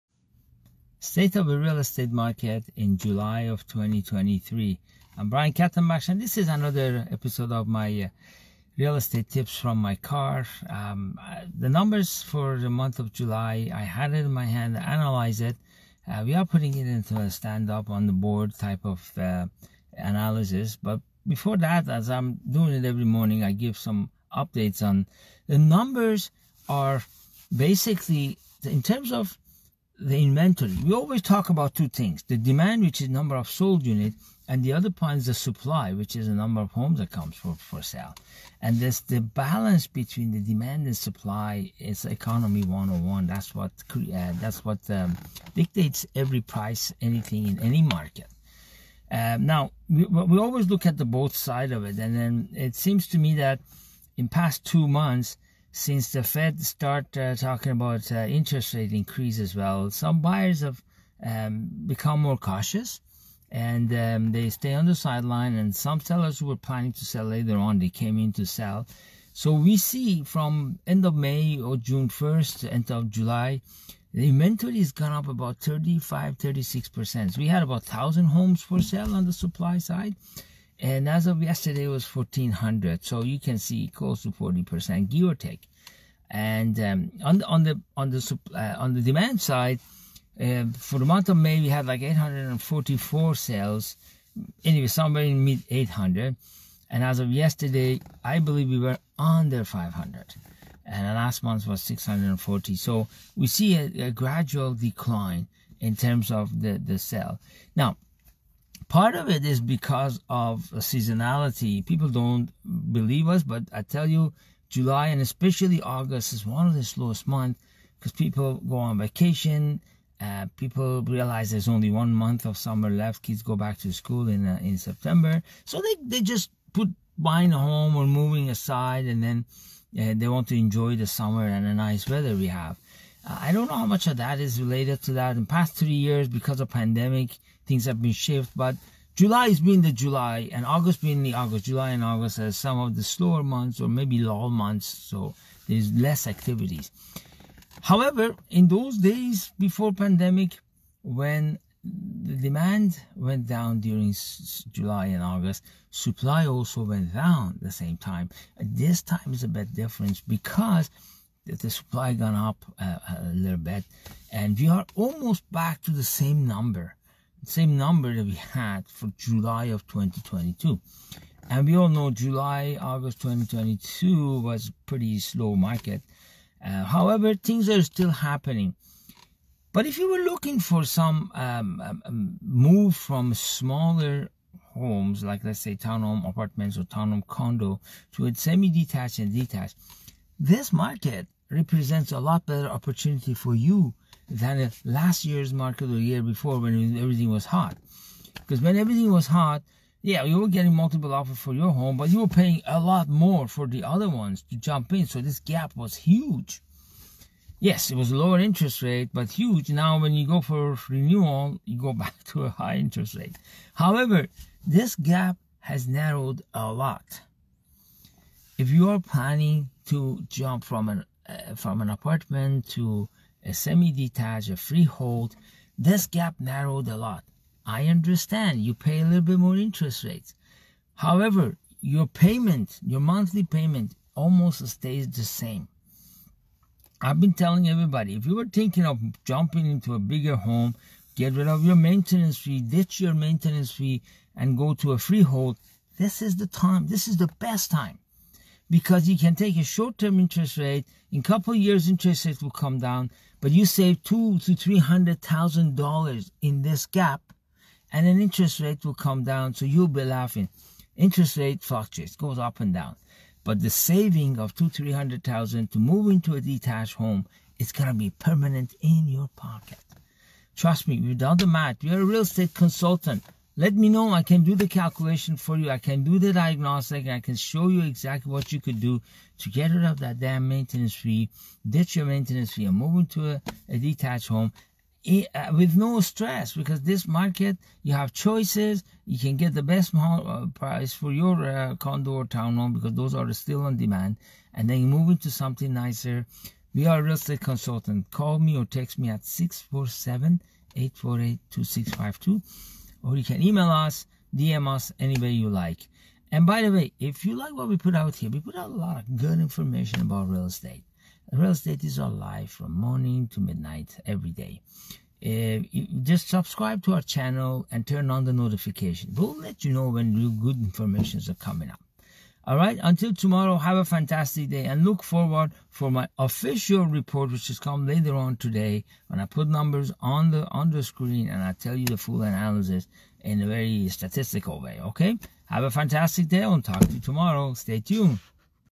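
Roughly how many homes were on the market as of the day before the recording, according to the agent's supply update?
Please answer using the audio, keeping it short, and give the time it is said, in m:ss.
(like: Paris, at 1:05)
1400, at 1:22.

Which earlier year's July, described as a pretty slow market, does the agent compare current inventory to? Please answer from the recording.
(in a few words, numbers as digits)
2022.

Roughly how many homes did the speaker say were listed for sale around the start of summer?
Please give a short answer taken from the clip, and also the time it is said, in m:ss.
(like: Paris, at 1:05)
1,000, at 1:17.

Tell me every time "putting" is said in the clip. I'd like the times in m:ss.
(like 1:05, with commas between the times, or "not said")
0:16.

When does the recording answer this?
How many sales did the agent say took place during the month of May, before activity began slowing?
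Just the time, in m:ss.
1:32.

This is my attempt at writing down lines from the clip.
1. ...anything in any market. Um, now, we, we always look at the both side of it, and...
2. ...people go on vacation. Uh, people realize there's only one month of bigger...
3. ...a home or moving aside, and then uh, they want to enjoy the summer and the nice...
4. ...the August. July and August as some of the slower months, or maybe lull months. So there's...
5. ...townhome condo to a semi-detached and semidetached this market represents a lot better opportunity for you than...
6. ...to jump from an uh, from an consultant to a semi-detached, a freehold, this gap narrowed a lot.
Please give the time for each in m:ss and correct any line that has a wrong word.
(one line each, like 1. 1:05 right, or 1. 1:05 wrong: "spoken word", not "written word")
1. 0:47 right
2. 1:58 wrong: "summer", not "bigger"
3. 2:07 right
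4. 2:21 right
5. 3:06 wrong: "detached", not "semidetached"
6. 3:39 wrong: "apartment", not "consultant".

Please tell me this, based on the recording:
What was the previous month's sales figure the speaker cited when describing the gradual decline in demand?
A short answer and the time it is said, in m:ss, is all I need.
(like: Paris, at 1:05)
640, at 1:41.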